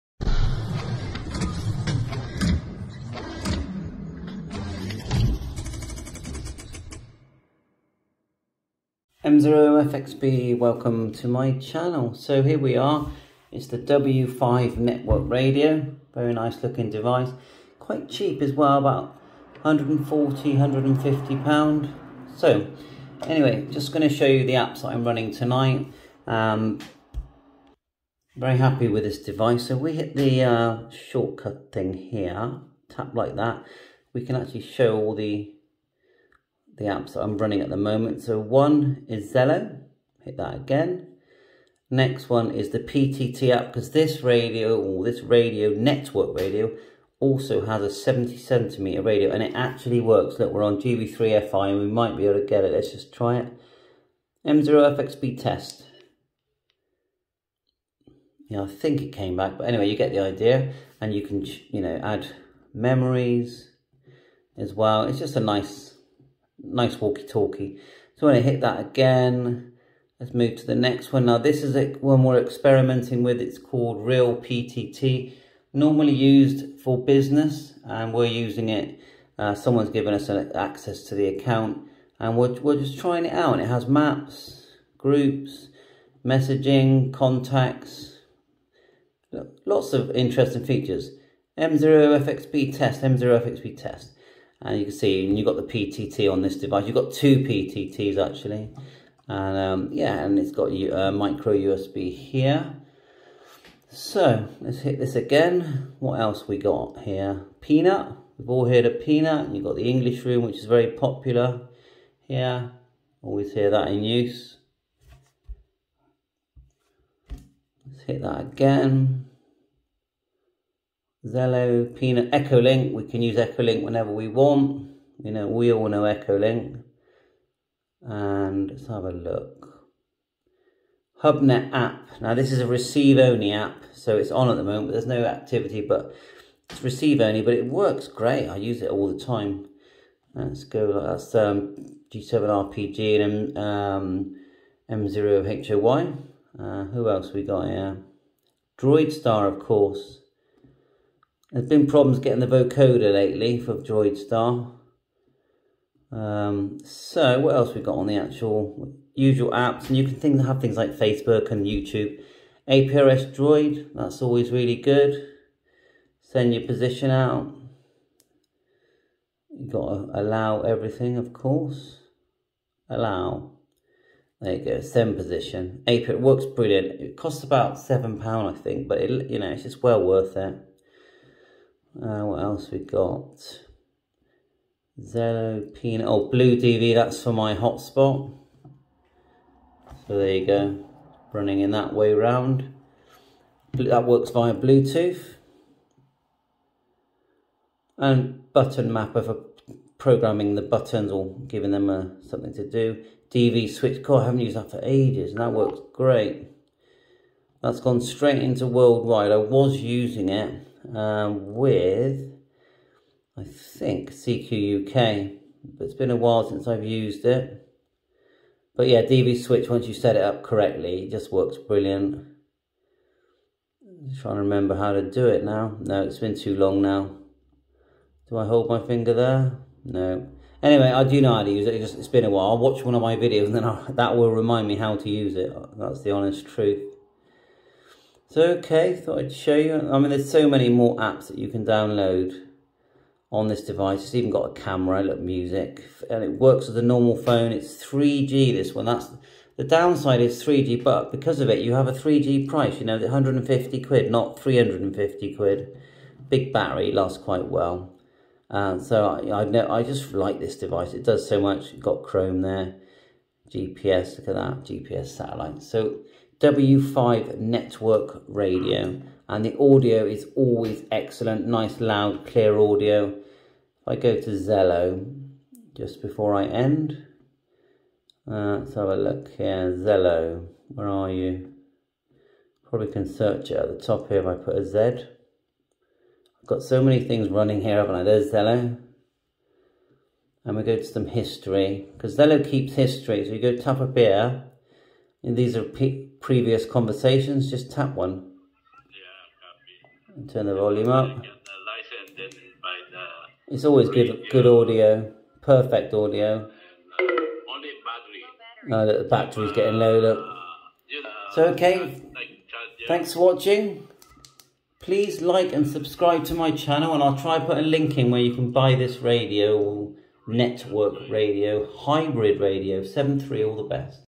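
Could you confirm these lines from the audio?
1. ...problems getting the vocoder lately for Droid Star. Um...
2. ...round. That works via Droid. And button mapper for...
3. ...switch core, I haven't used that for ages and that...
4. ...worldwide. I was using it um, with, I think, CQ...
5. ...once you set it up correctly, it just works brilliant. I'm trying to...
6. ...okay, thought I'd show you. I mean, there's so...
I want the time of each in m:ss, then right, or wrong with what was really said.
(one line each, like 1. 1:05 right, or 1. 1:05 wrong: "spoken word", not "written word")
1. 2:31 right
2. 3:12 wrong: "Bluetooth", not "Droid"
3. 3:23 right
4. 3:28 right
5. 3:39 right
6. 3:58 right.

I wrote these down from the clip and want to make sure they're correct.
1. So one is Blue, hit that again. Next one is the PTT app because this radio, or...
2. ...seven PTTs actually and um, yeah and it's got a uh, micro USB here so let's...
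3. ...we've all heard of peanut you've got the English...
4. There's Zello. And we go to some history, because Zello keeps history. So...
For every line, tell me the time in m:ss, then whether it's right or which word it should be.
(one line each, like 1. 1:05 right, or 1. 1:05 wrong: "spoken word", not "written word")
1. 0:38 wrong: "Zello", not "Blue"
2. 1:37 wrong: "two", not "seven"
3. 1:48 right
4. 4:48 right.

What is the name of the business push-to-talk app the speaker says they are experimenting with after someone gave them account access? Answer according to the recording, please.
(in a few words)
Real PTT.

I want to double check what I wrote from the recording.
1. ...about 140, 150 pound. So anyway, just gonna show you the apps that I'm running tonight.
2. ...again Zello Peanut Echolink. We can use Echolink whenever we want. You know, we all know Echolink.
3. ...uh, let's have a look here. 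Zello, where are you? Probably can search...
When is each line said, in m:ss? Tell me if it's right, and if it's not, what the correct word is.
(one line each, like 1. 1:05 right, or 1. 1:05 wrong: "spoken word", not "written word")
1. 0:18 right
2. 1:58 right
3. 4:38 right.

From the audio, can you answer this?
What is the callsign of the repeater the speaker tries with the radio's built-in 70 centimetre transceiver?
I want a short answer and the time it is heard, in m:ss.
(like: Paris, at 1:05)
GB3FI, at 0:50.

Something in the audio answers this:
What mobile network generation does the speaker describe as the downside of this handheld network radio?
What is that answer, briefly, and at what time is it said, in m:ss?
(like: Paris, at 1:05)
3G, at 4:09.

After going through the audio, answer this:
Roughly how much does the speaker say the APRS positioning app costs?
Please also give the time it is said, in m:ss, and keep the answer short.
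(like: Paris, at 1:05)
£7, at 2:57.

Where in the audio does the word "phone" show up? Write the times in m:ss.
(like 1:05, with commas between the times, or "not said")
4:07.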